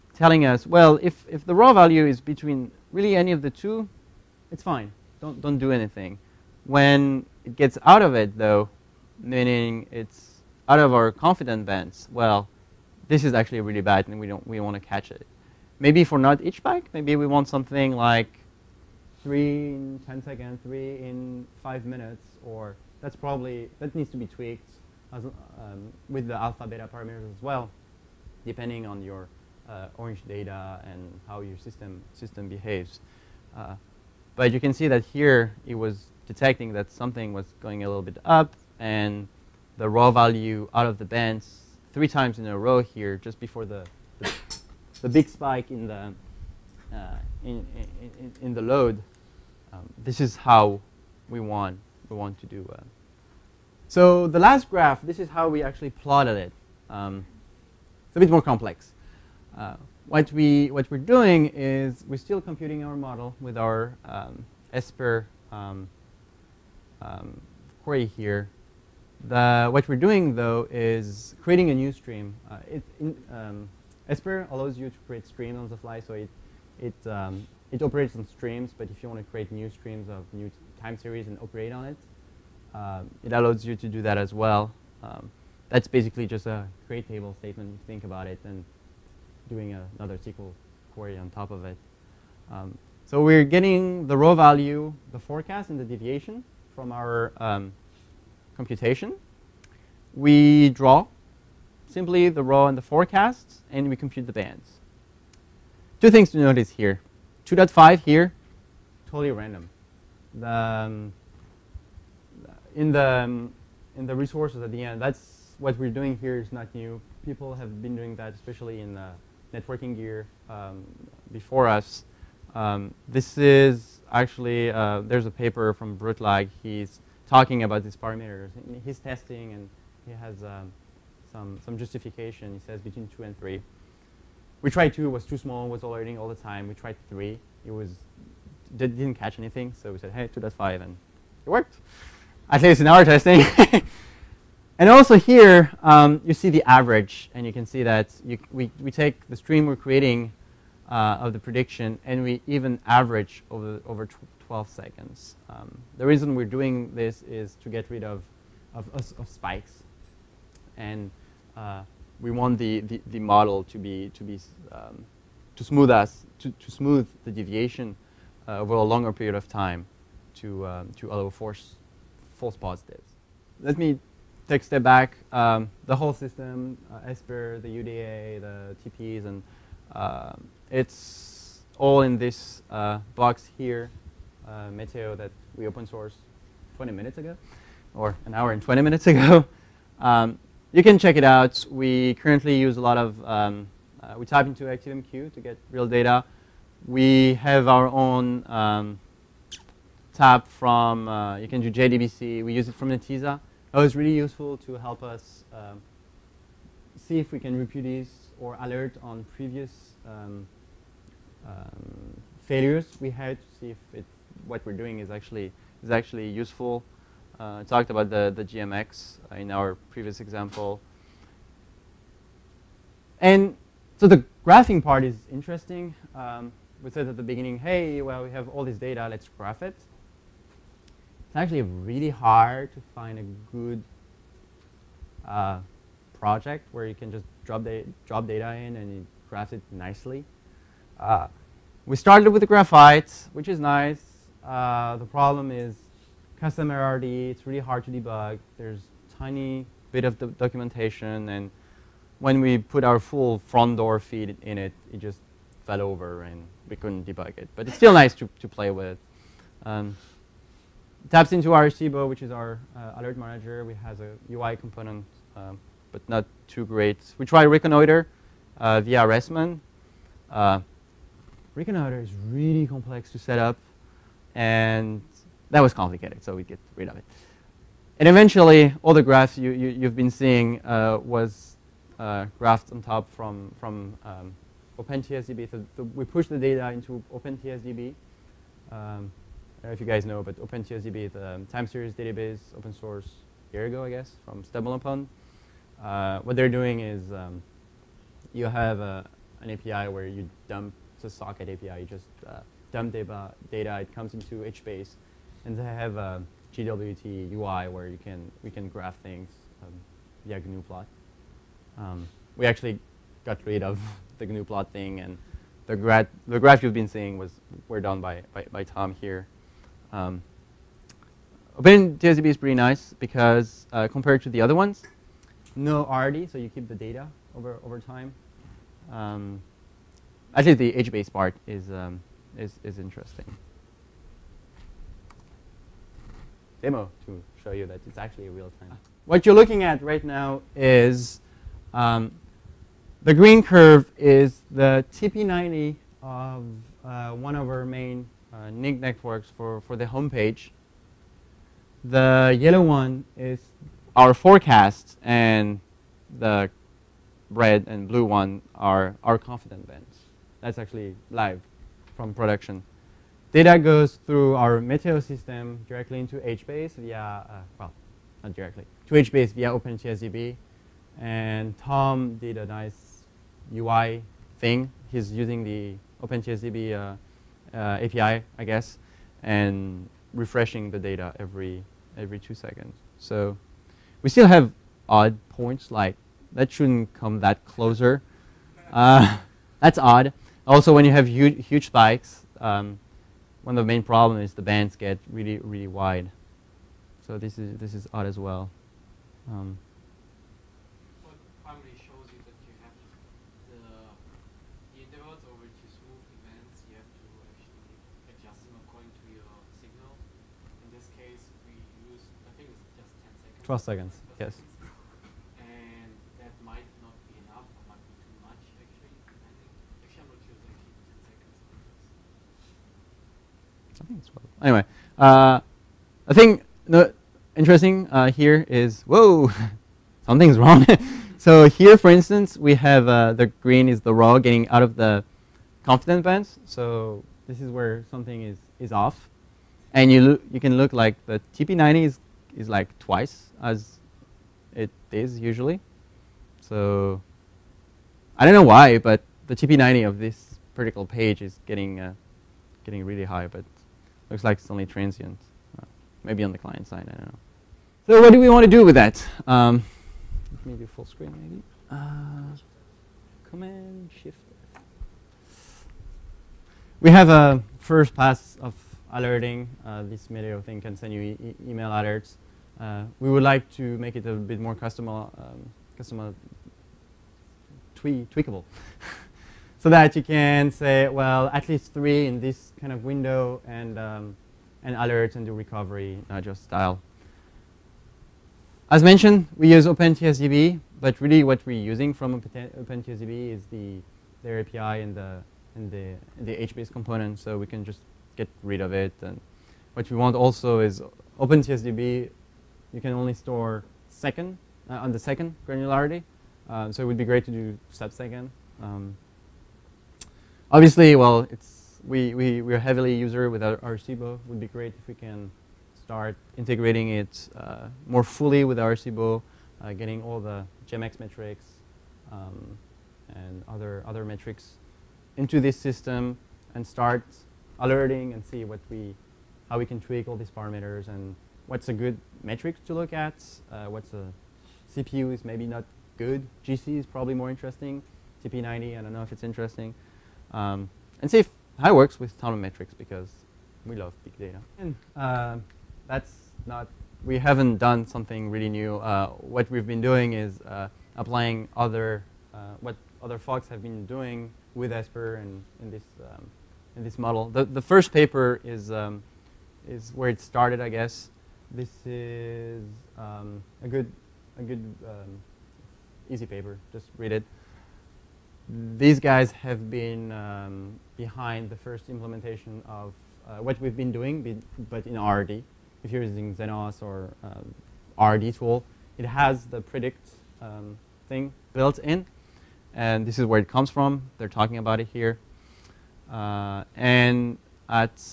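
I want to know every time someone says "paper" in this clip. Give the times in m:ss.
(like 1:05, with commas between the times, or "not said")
2:05, 9:17, 9:26.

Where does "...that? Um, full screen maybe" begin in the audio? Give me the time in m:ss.
7:38.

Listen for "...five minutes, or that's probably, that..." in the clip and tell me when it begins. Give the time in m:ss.
0:21.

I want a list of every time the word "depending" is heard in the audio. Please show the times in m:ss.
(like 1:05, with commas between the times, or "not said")
0:28.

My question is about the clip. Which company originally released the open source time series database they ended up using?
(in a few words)
StumbleUpon.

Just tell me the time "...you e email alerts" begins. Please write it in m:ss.
7:50.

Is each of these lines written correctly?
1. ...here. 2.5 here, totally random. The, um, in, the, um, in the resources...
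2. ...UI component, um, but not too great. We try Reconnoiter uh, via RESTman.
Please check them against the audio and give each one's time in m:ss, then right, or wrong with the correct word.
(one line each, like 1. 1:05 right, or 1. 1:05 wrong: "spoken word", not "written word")
1. 1:46 right
2. 4:24 right.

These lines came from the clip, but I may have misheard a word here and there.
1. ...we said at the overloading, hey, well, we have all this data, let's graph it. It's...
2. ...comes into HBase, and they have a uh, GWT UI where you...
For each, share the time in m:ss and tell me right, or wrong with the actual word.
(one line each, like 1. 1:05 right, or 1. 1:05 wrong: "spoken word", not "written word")
1. 3:46 wrong: "beginning", not "overloading"
2. 5:03 right.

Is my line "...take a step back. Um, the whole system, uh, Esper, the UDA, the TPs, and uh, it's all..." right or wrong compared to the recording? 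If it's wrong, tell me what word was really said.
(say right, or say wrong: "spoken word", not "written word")
right.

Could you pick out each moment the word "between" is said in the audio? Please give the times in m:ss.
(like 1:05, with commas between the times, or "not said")
0:02, 2:12.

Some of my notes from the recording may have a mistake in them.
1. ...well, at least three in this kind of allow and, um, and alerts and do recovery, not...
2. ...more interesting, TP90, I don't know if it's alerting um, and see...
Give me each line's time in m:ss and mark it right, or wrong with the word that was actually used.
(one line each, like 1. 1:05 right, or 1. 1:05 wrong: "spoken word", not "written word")
1. 8:00 wrong: "window", not "allow"
2. 8:57 wrong: "interesting", not "alerting".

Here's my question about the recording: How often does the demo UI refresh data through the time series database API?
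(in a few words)
Every 2 seconds.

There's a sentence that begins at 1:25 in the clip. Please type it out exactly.
Um, that's basically just a create table statement, you think about it, and doing a, another SQL query on top of it.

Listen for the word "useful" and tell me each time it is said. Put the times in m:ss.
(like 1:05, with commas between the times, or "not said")
3:24, 3:36.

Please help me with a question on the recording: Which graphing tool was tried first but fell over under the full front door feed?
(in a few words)
Graphite.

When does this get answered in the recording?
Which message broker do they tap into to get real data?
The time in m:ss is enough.
3:14.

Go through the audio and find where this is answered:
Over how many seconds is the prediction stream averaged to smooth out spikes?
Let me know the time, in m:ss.
2:34.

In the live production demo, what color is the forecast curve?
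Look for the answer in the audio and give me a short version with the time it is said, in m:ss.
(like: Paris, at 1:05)
Yellow, at 5:52.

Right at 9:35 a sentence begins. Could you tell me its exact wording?
If you're using Zenoss or um, RRDtool, it has the predict um, thing built in.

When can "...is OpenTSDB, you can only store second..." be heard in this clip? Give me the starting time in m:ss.
8:20.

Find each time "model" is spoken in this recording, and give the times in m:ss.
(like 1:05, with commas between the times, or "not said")
1:02, 2:43, 9:16.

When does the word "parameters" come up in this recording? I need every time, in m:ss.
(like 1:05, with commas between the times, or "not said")
0:26, 2:07, 8:50.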